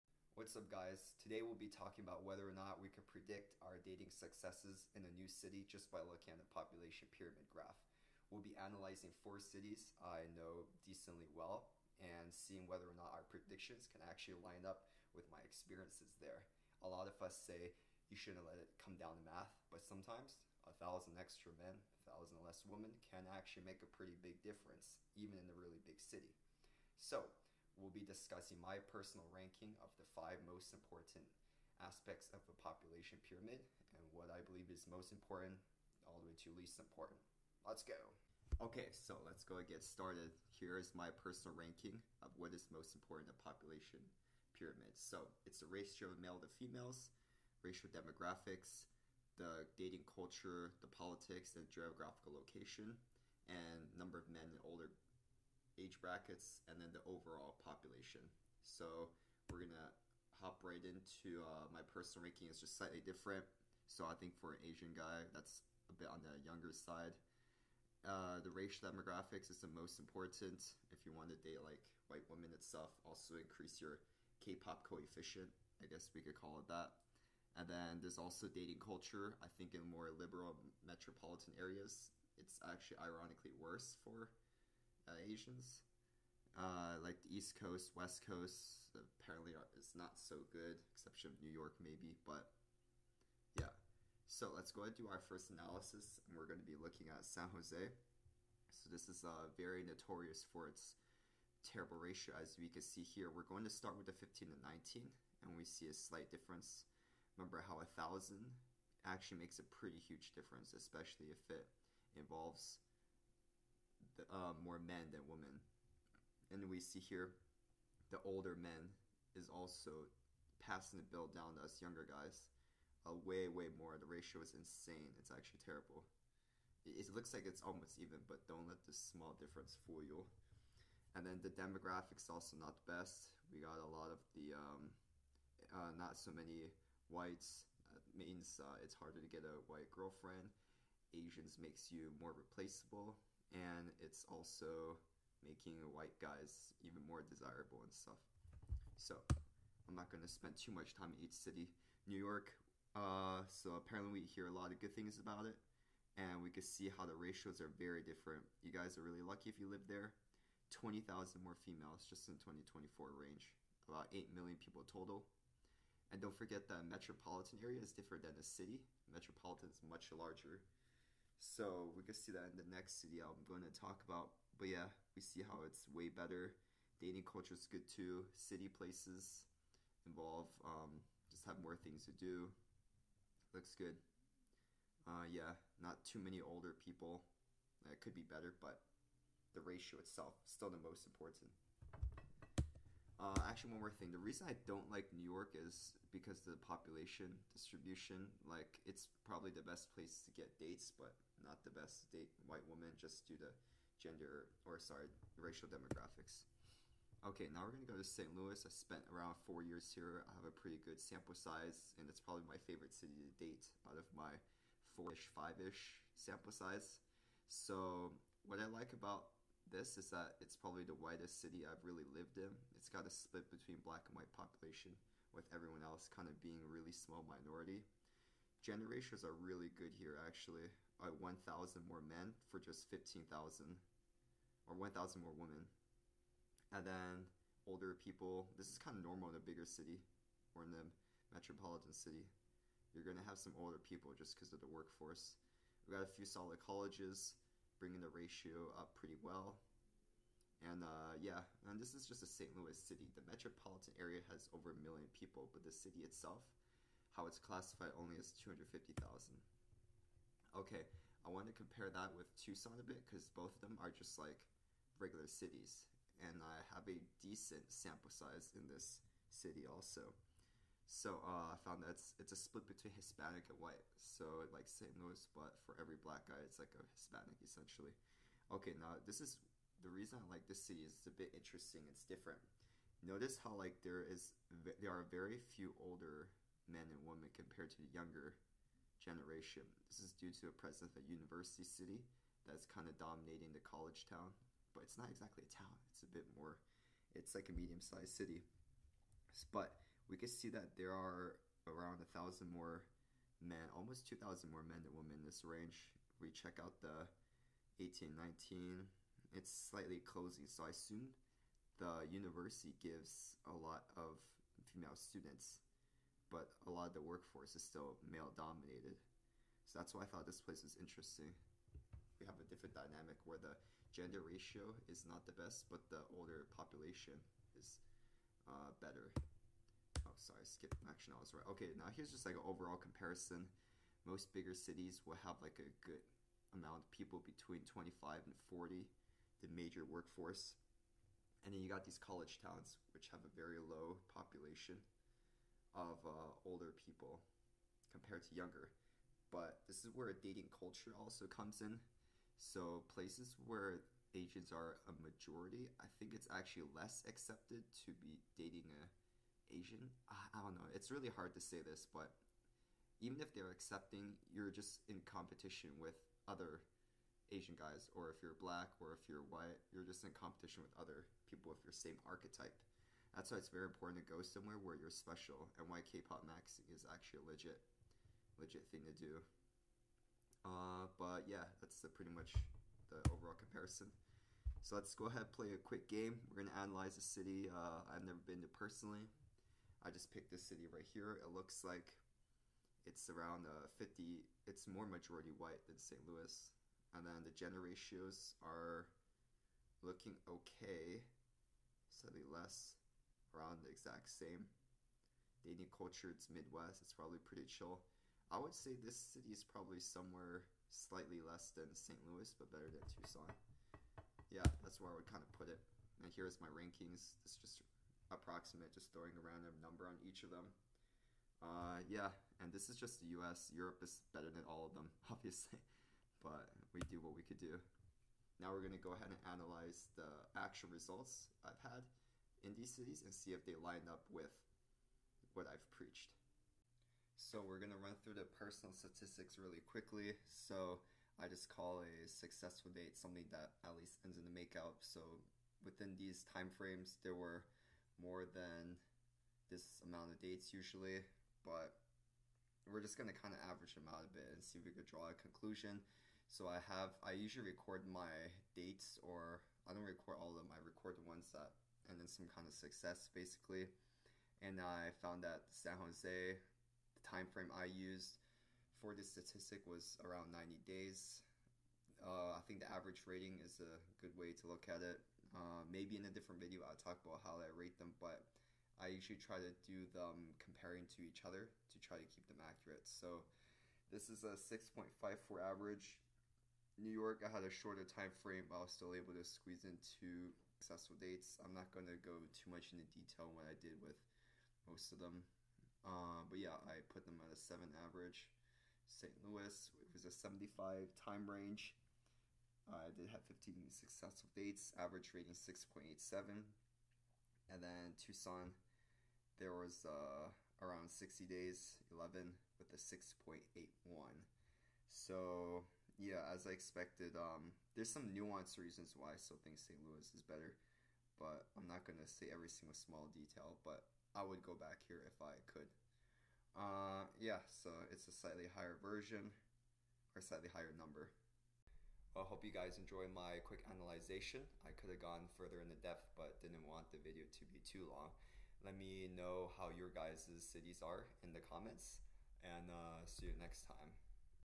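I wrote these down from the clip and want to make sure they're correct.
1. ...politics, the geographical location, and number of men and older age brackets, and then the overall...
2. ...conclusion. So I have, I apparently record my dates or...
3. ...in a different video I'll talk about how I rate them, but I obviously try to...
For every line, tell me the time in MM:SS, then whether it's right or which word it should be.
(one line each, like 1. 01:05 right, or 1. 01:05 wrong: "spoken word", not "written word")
1. 00:50 right
2. 07:35 wrong: "usually", not "apparently"
3. 07:55 wrong: "usually", not "obviously".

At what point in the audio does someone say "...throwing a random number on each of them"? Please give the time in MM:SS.
06:58.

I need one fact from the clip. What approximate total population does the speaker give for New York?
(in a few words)
8 million.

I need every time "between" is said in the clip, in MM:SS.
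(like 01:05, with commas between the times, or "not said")
03:43, 04:32, 05:37.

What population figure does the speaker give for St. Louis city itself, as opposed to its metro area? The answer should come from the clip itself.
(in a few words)
250,000.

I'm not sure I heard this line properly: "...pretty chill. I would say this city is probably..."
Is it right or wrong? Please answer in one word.
right.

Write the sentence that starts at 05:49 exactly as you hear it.
But this is where dating culture also comes in.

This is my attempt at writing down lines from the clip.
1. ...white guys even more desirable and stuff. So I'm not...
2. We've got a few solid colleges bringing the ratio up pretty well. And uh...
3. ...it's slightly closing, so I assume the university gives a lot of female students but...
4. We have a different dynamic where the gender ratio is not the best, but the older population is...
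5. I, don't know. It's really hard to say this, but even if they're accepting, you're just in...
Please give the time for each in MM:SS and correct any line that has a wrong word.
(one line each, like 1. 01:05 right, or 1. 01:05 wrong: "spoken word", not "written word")
1. 02:25 right
2. 04:05 right
3. 05:09 right
4. 05:22 right
5. 06:00 right.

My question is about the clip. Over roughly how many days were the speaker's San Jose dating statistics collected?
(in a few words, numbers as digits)
90.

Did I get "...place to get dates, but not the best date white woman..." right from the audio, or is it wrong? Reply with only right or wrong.
right.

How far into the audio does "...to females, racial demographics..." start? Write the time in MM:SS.
00:46.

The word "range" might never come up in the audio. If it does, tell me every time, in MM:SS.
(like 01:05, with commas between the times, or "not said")
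02:43, 05:05, 08:21.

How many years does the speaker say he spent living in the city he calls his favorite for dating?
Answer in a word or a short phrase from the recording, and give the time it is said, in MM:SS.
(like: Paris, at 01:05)
4, at 03:29.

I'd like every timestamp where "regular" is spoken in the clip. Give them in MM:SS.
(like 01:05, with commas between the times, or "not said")
04:24.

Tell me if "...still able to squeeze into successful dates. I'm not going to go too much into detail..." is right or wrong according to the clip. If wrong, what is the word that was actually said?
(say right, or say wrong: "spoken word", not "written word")
right.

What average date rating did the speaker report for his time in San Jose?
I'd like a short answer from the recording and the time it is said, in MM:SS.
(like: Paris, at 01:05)
6.54, at 08:04.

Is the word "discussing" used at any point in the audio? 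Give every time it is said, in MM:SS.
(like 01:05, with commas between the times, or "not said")
00:28.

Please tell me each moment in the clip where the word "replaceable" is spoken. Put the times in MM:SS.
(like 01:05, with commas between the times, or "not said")
02:22.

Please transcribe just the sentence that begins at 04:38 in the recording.
Okay, now this is the reason I like this city is it's a bit interesting.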